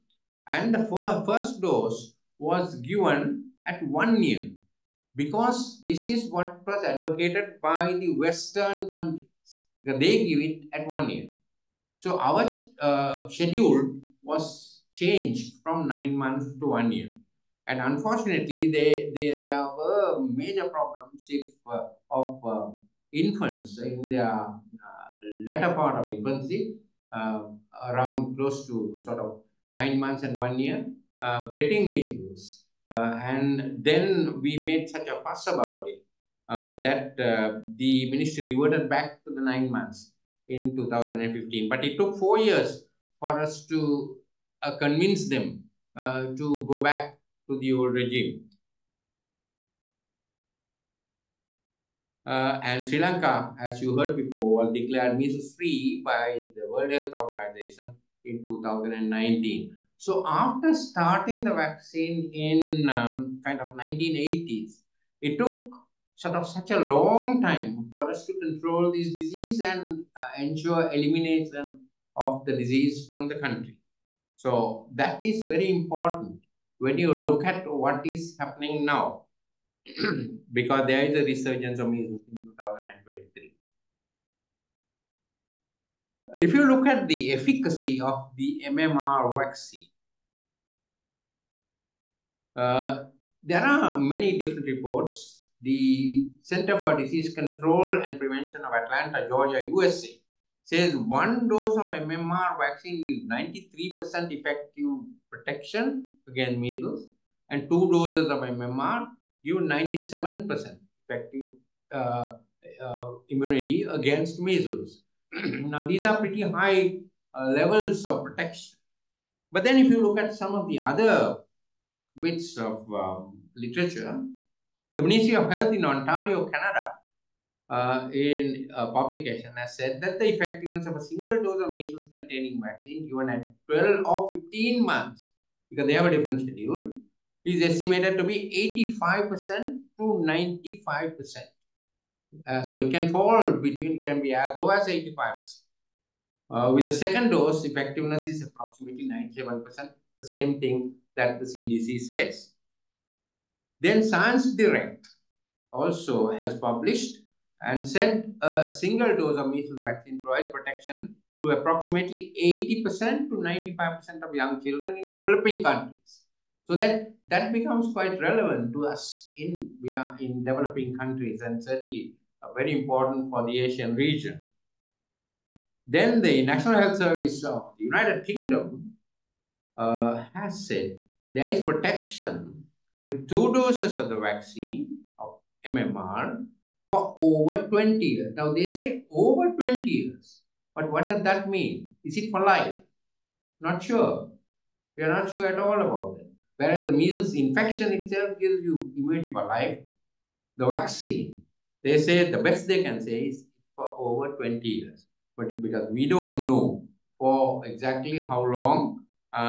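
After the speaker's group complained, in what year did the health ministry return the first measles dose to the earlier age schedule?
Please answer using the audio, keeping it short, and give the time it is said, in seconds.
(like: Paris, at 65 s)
2015, at 40 s.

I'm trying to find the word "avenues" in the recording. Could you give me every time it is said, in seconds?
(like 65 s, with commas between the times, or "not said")
not said.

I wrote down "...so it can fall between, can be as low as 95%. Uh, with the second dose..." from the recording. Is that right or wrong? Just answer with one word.
wrong.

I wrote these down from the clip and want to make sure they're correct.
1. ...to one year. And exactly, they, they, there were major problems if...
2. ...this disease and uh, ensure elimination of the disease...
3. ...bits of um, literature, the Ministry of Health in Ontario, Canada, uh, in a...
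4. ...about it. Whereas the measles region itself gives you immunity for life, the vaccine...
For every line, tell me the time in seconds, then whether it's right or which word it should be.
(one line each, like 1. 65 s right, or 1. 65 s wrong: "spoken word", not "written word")
1. 16 s wrong: "unfortunately", not "exactly"
2. 68 s right
3. 122 s right
4. 195 s wrong: "infection", not "region".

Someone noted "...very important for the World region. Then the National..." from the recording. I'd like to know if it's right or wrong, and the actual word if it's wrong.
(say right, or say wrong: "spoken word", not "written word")
wrong: "Asian", not "World".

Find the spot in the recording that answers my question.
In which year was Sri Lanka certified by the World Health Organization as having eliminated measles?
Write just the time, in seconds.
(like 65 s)
58 s.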